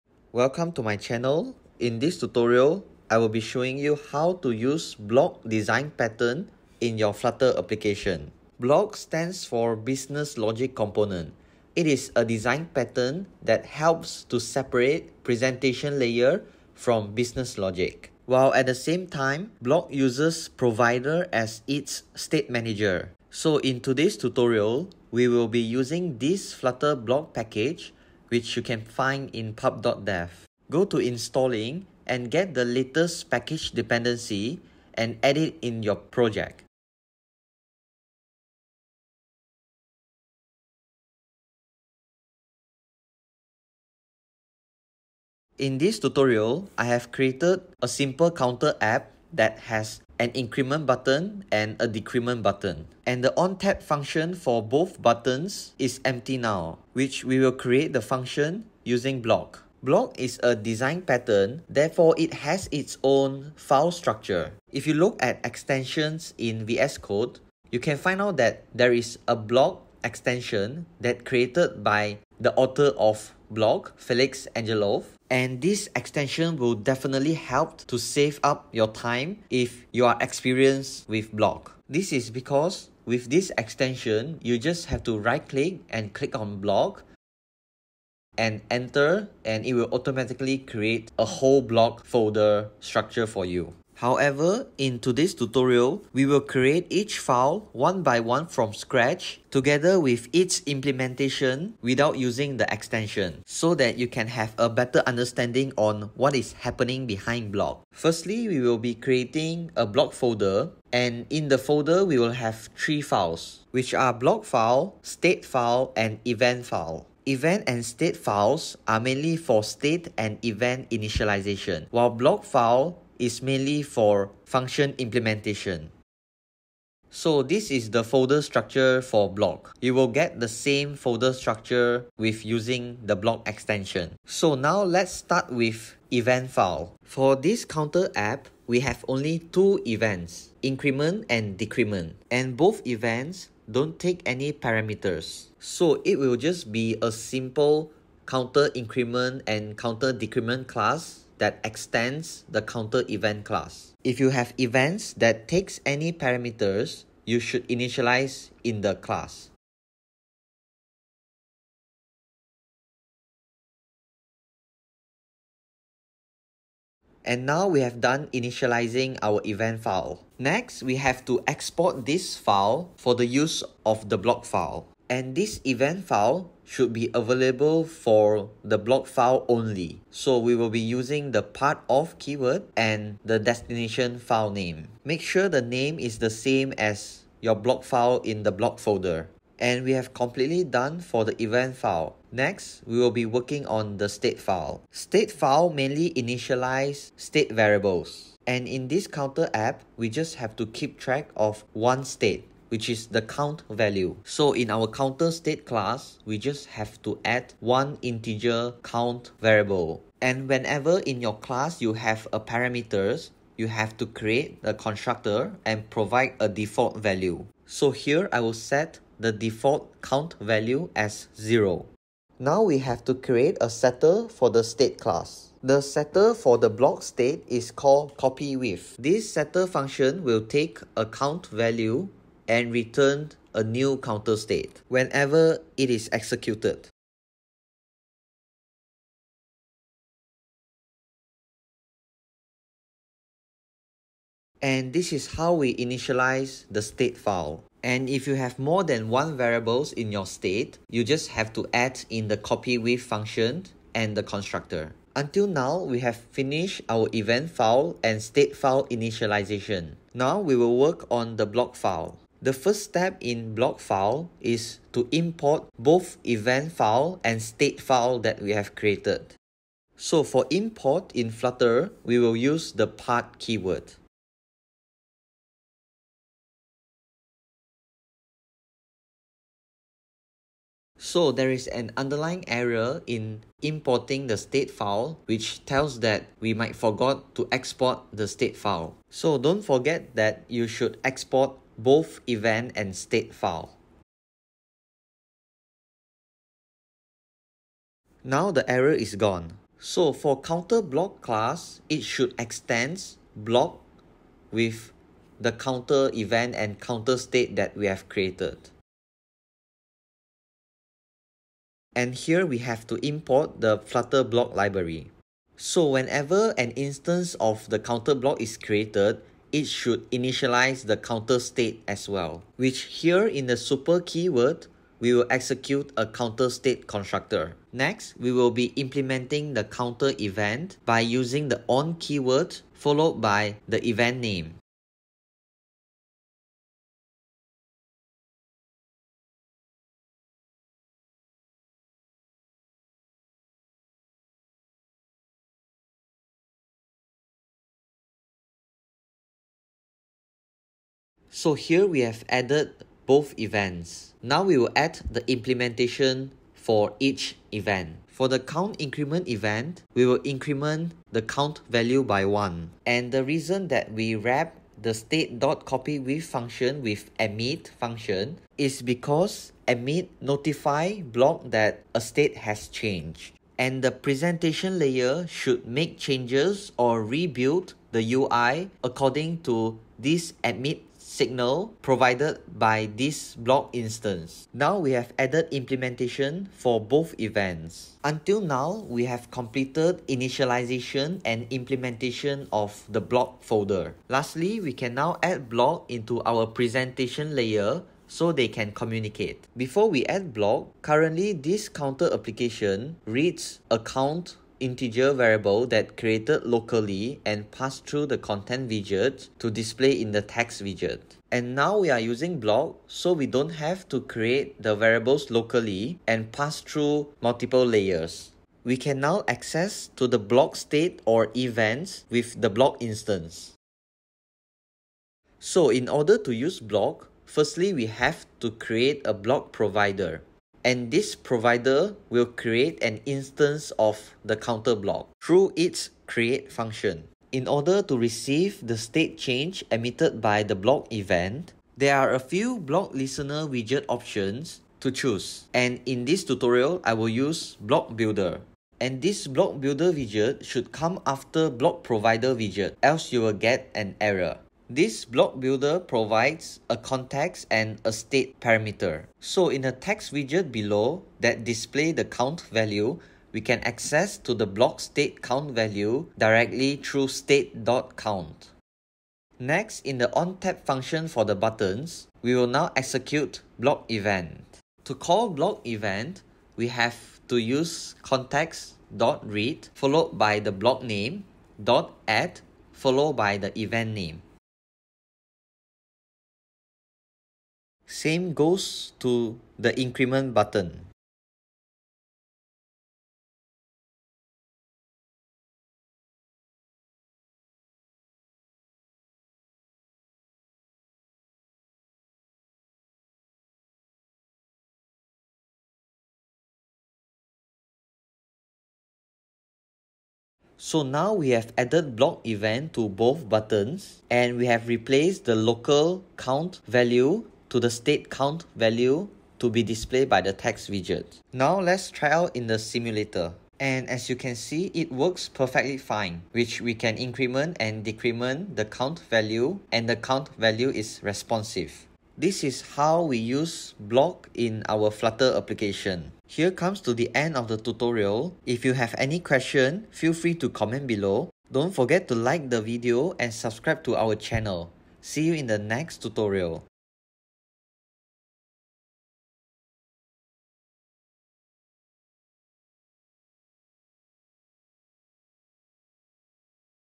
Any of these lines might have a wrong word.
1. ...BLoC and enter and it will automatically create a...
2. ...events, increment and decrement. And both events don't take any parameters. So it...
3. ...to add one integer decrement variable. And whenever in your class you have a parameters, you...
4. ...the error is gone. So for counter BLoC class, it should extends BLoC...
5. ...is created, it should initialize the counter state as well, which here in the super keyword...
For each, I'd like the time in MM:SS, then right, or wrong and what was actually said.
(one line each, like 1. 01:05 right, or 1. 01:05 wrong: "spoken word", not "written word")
1. 01:26 right
2. 02:19 right
3. 03:27 wrong: "count", not "decrement"
4. 04:58 right
5. 05:18 right.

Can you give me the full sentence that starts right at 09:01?
Don't forget to like the video and subscribe to our channel.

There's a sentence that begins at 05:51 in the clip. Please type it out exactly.
So here we have added both events.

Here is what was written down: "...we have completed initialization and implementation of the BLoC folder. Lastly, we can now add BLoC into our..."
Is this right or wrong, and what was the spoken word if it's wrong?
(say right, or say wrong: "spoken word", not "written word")
right.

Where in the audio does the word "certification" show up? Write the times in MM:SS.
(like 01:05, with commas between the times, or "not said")
not said.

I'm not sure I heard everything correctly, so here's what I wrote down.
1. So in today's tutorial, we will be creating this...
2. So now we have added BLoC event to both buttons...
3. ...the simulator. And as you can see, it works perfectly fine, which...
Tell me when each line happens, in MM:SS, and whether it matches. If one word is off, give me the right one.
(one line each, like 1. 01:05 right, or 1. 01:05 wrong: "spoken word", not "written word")
1. 00:23 wrong: "using", not "creating"
2. 08:30 right
3. 08:42 right.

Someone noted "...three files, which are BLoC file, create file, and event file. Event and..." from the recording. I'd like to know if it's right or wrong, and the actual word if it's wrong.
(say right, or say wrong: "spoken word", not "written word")
wrong: "state", not "create".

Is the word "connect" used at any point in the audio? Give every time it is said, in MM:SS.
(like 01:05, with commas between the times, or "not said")
not said.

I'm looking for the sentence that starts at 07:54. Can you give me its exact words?
To call BLoC event, we have to use context.read followed by the BLoC name, dot add followed by the event name.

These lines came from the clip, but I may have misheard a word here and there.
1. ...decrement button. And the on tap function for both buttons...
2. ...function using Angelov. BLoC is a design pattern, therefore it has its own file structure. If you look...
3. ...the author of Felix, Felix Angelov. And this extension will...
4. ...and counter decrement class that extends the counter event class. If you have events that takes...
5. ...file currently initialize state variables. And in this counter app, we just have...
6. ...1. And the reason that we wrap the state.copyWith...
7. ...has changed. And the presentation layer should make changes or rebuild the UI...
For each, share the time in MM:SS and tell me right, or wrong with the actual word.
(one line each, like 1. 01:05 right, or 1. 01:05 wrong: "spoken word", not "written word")
1. 00:51 right
2. 00:58 wrong: "BLoC", not "Angelov"
3. 01:12 wrong: "BLoC", not "Felix"
4. 02:29 right
5. 03:15 wrong: "mainly", not "currently"
6. 06:02 right
7. 06:12 right.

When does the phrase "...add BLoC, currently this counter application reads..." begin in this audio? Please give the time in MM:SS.
06:40.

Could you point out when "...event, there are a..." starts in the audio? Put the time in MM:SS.
07:20.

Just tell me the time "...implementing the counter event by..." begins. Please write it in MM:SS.
05:28.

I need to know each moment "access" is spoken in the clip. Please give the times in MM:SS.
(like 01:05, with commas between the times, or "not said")
06:59, 07:43.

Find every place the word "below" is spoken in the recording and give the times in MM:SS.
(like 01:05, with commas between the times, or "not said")
07:40, 09:00.